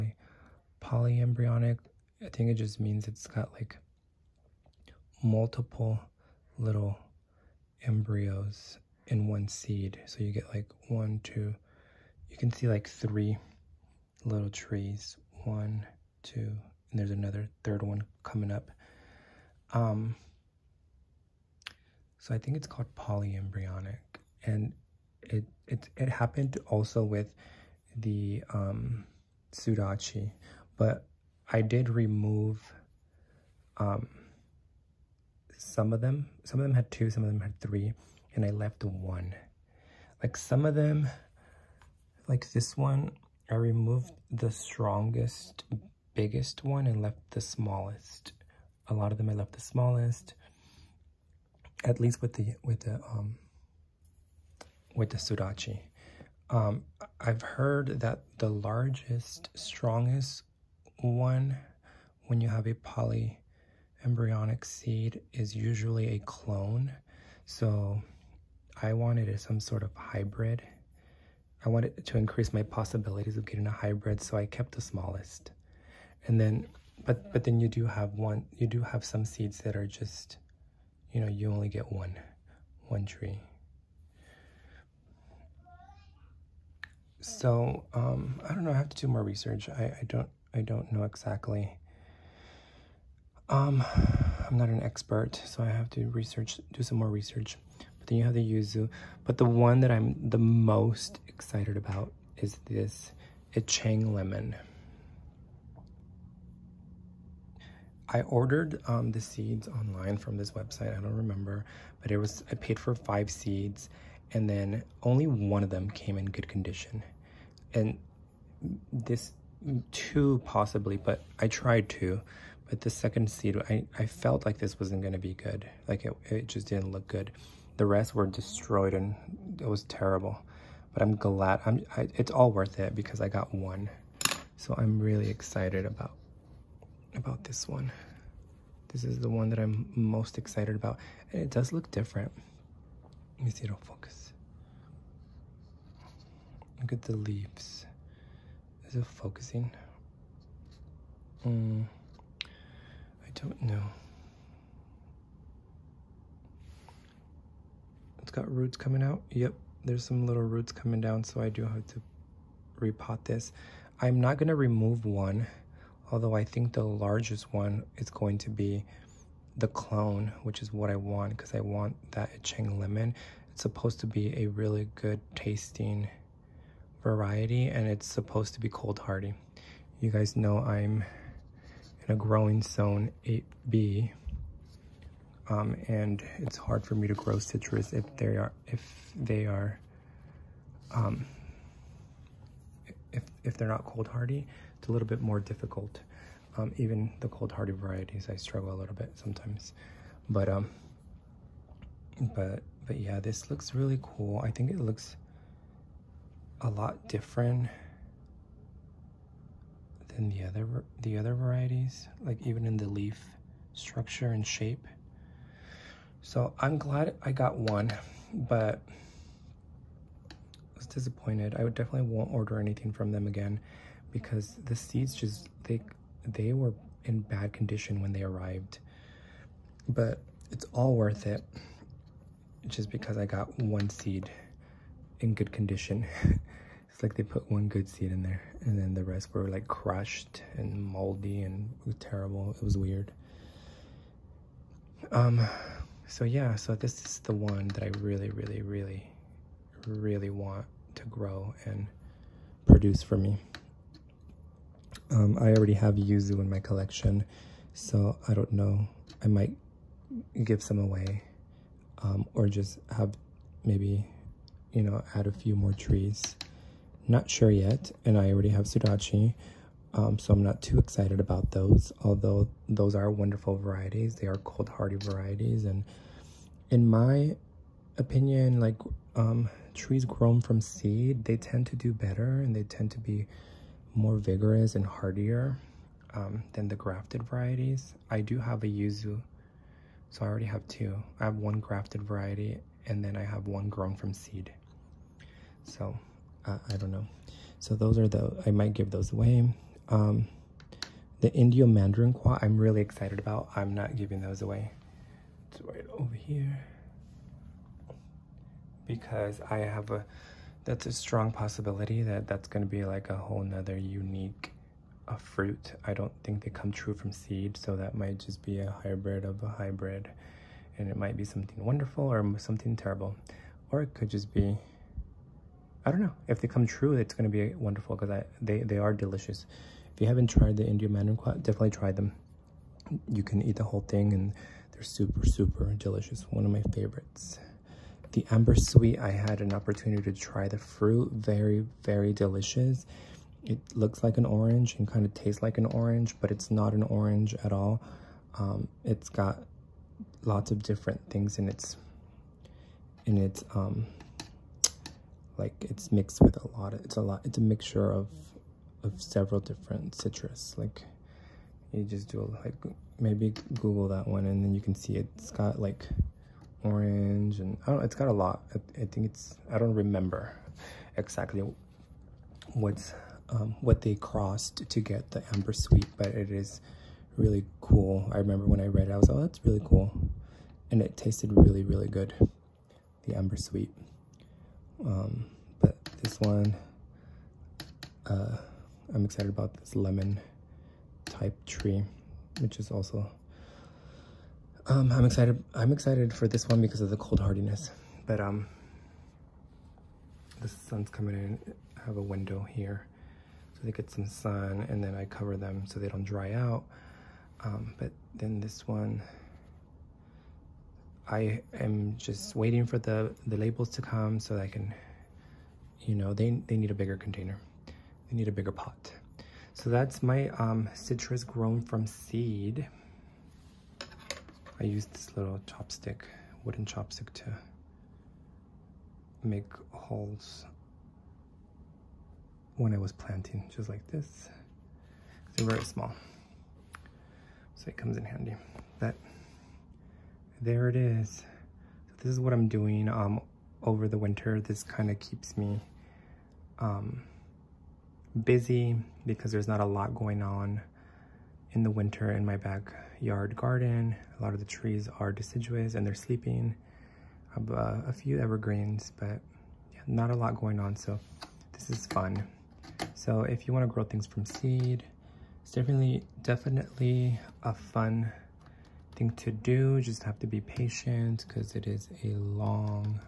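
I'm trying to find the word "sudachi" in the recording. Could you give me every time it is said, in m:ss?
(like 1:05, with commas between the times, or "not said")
0:29, 0:55, 4:28.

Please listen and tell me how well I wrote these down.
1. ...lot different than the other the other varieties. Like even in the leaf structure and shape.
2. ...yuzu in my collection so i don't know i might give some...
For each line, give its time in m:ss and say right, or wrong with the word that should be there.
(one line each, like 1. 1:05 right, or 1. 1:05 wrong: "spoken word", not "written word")
1. 3:26 right
2. 4:15 right.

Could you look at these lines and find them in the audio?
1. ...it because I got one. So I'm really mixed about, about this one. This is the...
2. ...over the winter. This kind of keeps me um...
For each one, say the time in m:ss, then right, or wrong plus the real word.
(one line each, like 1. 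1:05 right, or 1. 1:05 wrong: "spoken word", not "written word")
1. 2:12 wrong: "excited", not "mixed"
2. 7:23 right.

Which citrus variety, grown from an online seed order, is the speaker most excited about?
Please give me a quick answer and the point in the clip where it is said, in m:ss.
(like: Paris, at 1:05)
Ichang lemon, at 1:43.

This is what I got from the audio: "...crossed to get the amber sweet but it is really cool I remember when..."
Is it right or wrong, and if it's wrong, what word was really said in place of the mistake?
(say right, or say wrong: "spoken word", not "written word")
right.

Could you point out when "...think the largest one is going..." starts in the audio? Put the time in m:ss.
2:46.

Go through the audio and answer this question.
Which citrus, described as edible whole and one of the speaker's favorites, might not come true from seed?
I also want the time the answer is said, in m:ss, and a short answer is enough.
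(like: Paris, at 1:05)
Indio Mandarinquat, at 5:01.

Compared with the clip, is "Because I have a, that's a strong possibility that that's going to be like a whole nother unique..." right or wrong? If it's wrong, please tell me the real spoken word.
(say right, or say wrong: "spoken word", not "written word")
right.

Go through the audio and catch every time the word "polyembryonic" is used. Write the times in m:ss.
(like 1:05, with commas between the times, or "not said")
0:00, 0:22, 1:02.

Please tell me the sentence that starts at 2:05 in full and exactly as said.
Like it it just didn't look good.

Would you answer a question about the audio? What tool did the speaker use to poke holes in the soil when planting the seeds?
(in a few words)
Wooden chopstick.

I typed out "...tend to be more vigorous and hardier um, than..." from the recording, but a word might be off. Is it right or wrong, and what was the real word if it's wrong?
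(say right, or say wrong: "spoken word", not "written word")
right.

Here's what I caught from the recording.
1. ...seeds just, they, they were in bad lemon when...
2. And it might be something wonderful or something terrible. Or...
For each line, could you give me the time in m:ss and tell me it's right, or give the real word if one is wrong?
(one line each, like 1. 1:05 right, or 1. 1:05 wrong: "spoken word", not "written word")
1. 3:44 wrong: "condition", not "lemon"
2. 5:20 right.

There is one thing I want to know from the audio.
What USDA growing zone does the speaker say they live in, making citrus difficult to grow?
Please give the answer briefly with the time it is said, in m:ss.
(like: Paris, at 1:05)
8B, at 3:02.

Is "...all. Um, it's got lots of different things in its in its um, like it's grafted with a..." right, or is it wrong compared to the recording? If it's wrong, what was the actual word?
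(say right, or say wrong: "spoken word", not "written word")
wrong: "mixed", not "grafted".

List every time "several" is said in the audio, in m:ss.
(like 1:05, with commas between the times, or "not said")
5:59.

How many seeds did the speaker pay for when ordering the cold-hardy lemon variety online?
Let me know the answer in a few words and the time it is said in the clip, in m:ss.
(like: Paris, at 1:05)
5, at 1:52.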